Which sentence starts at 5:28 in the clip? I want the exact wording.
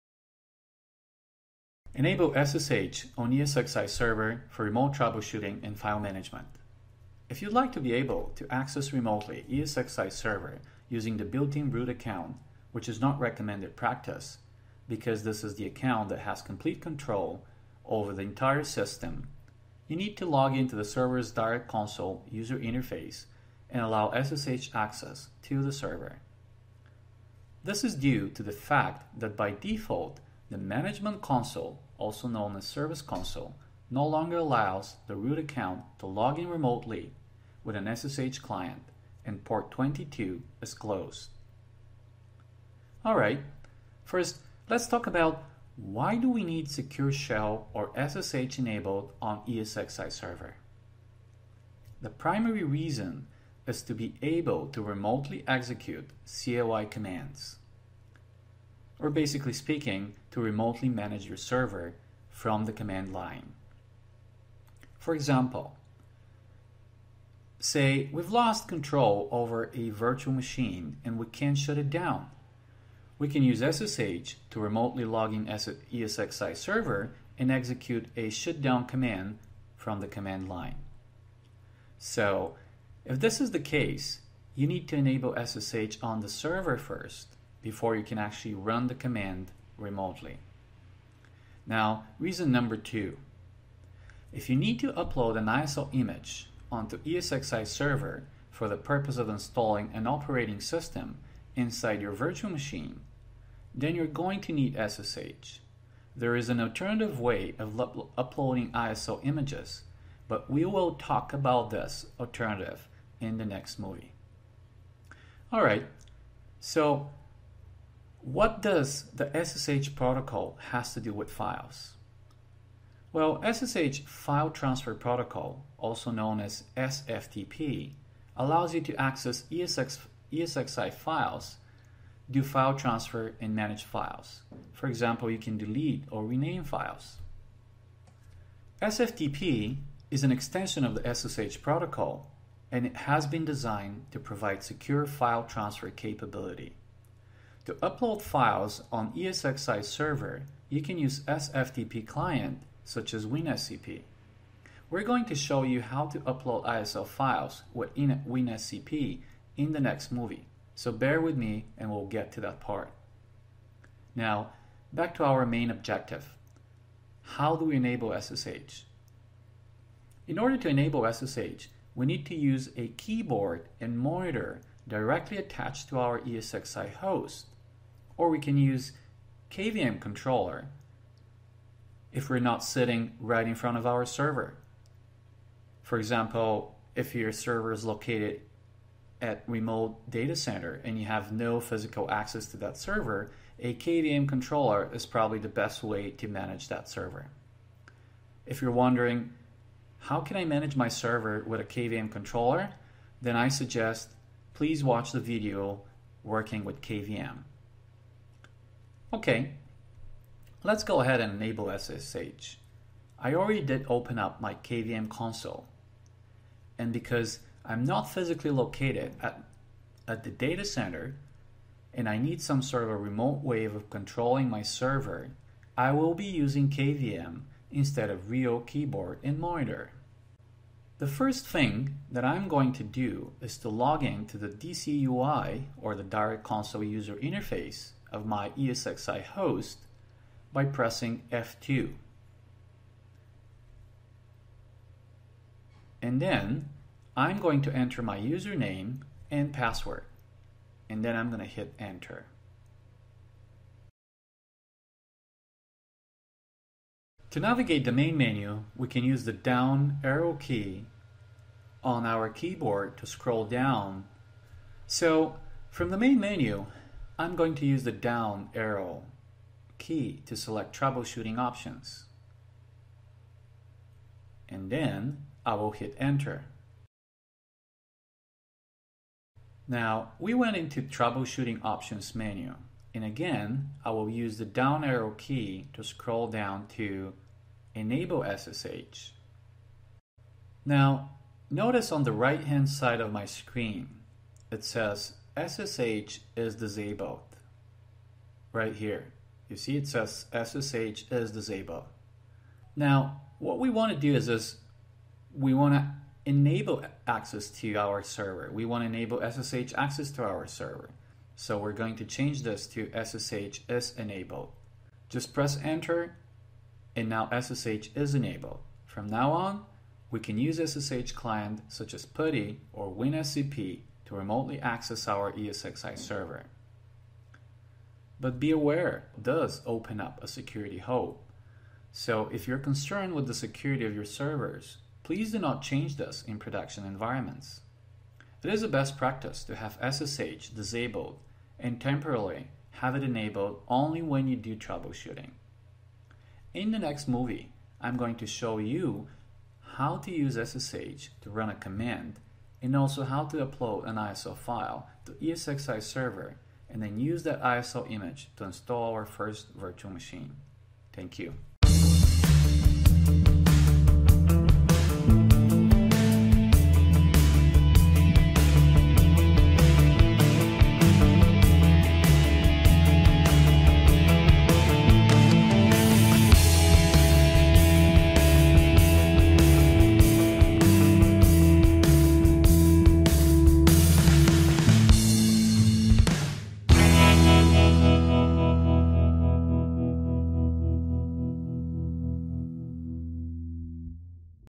But be aware, does open up a security hole.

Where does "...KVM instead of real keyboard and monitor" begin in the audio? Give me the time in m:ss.
3:46.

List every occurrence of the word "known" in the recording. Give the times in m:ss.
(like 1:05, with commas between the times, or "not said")
0:32, 2:06.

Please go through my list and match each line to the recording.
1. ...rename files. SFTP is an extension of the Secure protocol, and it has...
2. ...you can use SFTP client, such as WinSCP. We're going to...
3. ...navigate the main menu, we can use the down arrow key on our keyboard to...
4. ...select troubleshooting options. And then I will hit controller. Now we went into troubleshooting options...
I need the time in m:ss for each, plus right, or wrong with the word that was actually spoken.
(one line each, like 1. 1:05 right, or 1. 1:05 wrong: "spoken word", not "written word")
1. 2:16 wrong: "SSH", not "Secure"
2. 2:30 right
3. 4:17 right
4. 4:30 wrong: "enter", not "controller".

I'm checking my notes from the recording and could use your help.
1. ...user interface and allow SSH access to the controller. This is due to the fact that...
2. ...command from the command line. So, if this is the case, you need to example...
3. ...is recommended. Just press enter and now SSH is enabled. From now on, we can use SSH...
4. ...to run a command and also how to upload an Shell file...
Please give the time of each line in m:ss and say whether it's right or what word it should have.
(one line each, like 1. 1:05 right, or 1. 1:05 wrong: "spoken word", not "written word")
1. 0:22 wrong: "server", not "controller"
2. 1:18 wrong: "enable", not "example"
3. 5:13 wrong: "enabled", not "recommended"
4. 5:51 wrong: "ISO", not "Shell".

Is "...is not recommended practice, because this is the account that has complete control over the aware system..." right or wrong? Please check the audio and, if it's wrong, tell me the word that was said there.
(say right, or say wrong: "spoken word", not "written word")
wrong: "entire", not "aware".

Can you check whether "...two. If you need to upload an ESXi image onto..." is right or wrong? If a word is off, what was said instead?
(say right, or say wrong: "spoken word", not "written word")
wrong: "ISO", not "ESXi".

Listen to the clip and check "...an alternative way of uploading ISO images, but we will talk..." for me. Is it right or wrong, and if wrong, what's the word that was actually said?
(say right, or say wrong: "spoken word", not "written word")
right.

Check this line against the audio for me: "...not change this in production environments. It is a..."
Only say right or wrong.
right.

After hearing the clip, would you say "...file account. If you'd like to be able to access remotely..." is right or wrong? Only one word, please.
wrong.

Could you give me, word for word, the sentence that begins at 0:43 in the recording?
Alright, first let's talk about why do we need Secure Shell or SSH enabled on ESXi server?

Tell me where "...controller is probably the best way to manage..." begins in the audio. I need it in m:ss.
3:14.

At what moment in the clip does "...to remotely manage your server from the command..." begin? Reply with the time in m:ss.
1:00.